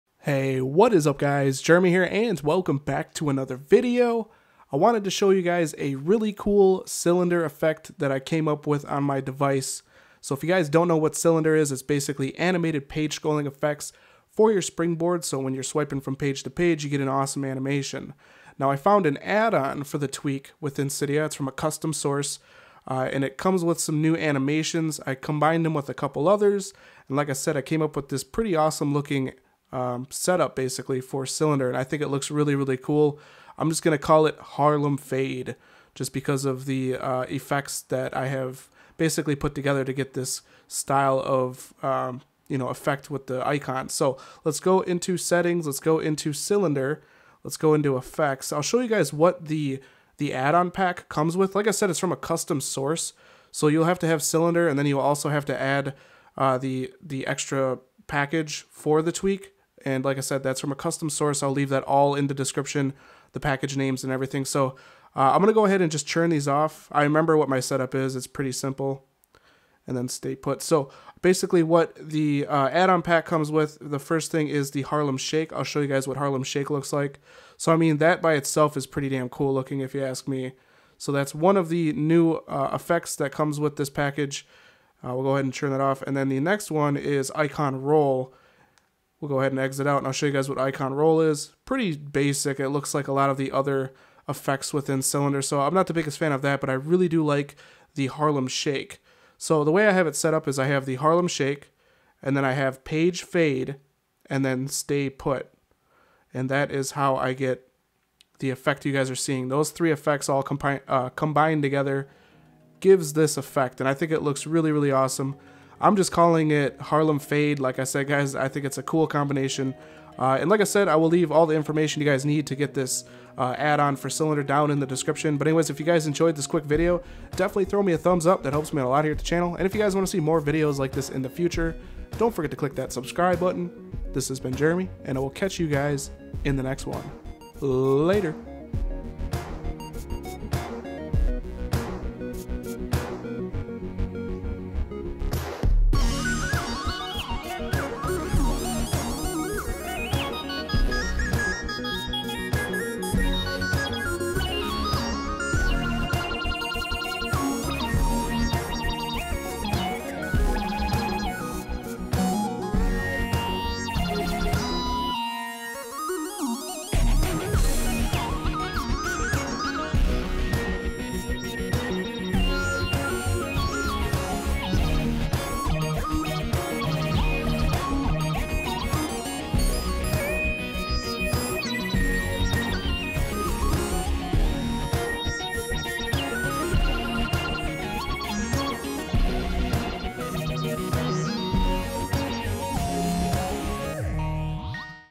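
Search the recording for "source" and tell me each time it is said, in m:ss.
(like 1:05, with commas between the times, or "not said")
0:21, 0:52, 1:01.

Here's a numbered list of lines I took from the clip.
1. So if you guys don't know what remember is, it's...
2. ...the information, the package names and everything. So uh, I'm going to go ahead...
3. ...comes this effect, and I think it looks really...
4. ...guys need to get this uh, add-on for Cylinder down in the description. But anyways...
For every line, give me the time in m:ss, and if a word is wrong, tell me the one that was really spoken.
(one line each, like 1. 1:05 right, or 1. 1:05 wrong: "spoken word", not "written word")
1. 0:10 wrong: "cylinder", not "remember"
2. 1:02 wrong: "description", not "information"
3. 1:52 wrong: "gives", not "comes"
4. 2:02 right.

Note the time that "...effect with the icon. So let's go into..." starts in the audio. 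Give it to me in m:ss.
0:42.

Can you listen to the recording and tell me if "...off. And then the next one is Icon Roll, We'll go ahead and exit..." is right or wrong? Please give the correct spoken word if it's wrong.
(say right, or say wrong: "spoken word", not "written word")
right.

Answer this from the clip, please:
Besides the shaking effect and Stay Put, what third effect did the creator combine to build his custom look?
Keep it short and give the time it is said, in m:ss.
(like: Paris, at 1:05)
Page Fade, at 1:42.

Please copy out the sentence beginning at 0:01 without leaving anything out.
Jeremy here and welcome back to another video.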